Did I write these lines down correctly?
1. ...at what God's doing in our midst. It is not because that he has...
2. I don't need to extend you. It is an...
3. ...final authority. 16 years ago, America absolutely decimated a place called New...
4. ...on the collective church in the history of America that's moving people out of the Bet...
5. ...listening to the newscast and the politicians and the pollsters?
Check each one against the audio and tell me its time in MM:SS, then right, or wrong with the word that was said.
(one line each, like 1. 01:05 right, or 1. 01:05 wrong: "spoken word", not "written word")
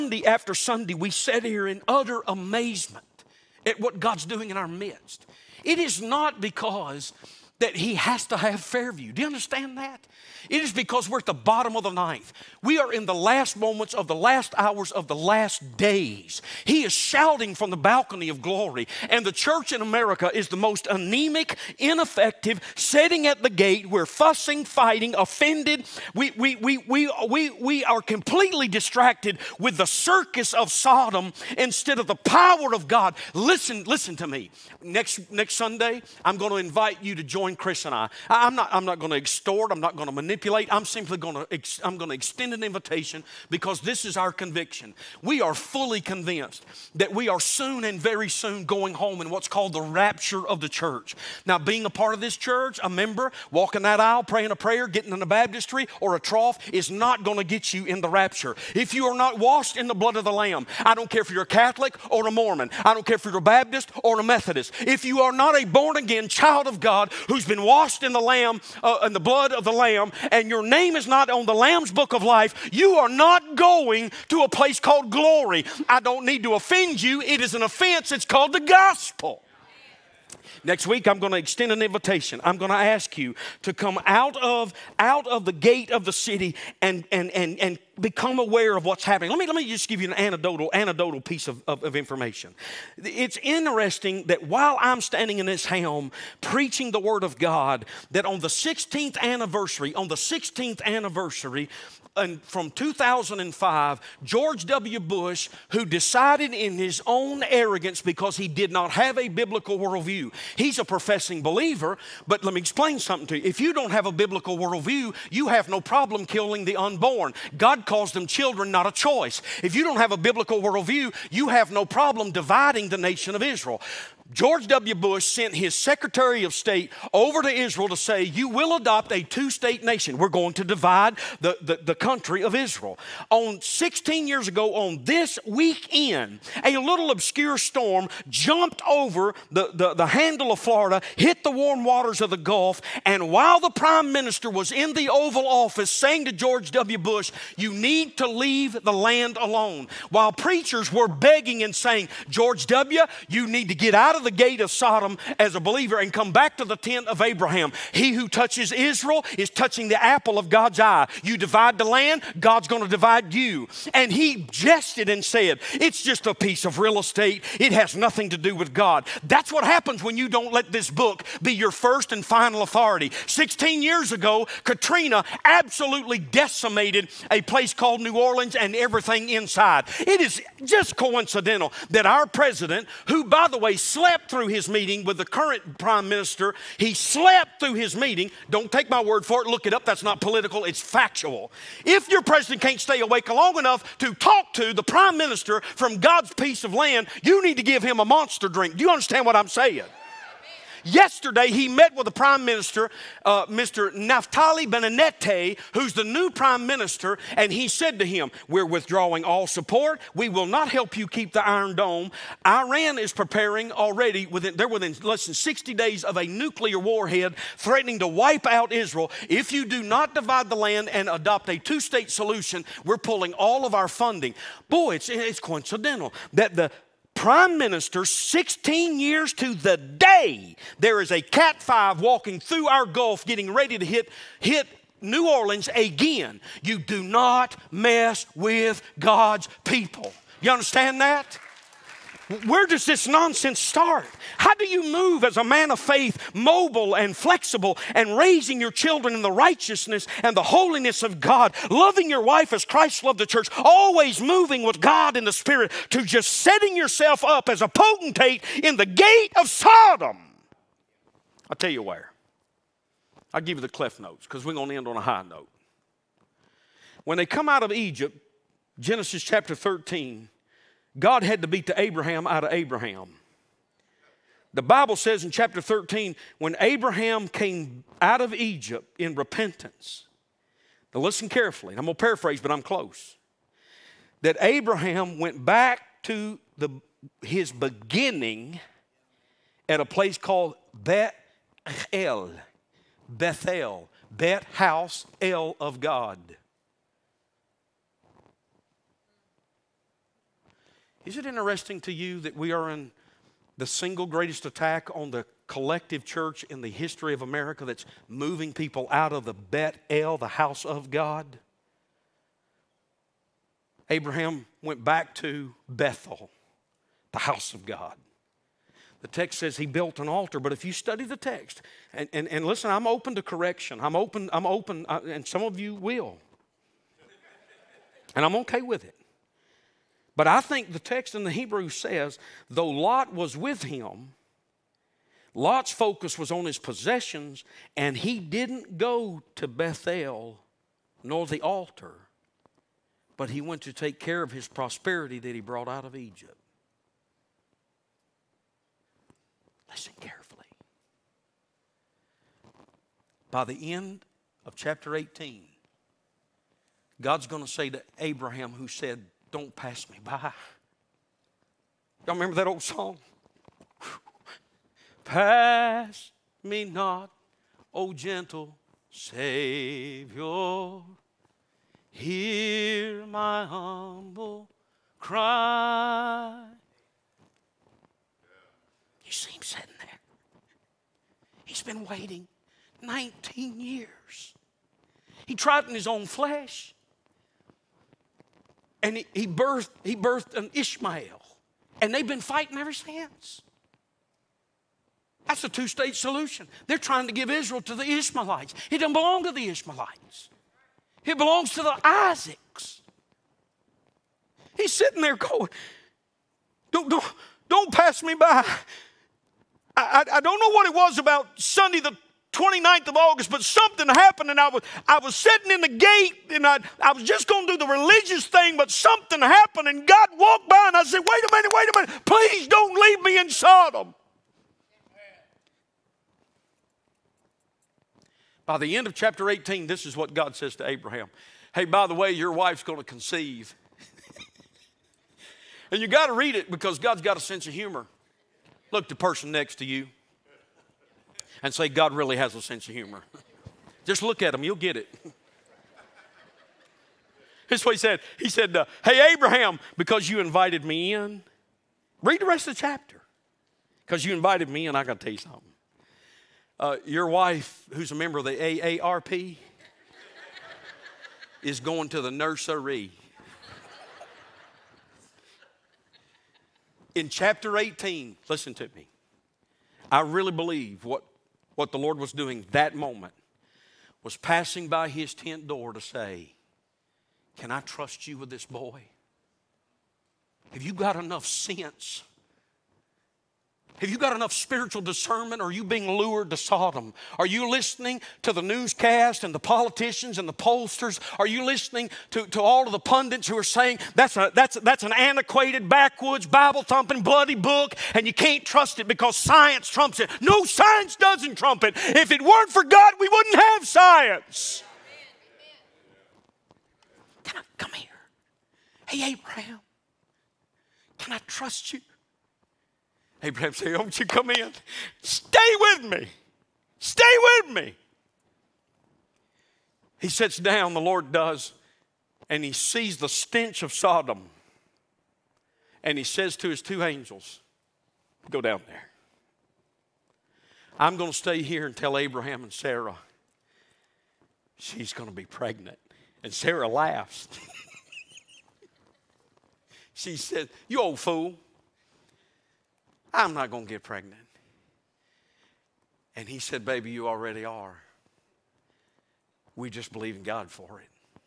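1. 00:03 right
2. 01:15 wrong: "offend", not "extend"
3. 02:52 wrong: "Katrina", not "America"
4. 05:04 right
5. 08:07 right.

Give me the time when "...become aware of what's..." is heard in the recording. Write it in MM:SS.
01:28.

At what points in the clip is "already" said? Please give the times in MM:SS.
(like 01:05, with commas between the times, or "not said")
03:33, 09:07.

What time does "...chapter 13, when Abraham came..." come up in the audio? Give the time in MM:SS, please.
04:35.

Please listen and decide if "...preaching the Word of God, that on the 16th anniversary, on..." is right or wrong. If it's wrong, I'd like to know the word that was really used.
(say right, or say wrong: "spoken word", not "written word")
right.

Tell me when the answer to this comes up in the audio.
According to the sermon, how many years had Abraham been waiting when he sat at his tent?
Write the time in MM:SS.
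06:22.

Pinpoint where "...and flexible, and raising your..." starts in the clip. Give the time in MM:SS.
04:06.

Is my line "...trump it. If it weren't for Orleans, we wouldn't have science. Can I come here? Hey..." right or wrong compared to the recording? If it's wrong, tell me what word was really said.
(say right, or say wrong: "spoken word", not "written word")
wrong: "God", not "Orleans".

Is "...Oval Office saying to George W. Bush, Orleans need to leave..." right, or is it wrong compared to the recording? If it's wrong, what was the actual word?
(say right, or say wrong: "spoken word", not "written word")
wrong: "You", not "Orleans".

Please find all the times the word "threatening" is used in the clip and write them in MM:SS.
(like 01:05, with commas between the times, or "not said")
03:37.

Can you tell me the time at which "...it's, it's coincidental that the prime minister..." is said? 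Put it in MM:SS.
03:44.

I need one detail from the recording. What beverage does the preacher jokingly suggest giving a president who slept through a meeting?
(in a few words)
a monster drink.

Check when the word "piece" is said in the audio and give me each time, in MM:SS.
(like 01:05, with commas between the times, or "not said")
01:31, 02:46, 03:16.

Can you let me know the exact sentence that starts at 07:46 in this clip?
In chapter 18, listen to me.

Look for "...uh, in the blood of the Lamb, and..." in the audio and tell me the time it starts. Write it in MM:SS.
01:08.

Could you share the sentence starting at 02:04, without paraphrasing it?
Bush sent his Secretary of State over to Israel to say, You will adopt a two state nation.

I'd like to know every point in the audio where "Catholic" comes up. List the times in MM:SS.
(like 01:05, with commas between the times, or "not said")
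01:01.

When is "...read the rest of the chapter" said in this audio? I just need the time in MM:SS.
07:32.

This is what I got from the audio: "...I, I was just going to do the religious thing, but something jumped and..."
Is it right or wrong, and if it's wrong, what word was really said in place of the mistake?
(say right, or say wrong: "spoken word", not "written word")
wrong: "happened", not "jumped".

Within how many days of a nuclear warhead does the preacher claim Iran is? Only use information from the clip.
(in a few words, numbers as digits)
60.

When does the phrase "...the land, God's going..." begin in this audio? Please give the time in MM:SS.
02:41.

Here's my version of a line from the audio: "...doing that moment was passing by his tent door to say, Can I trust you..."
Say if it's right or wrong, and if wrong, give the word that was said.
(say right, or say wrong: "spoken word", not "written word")
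right.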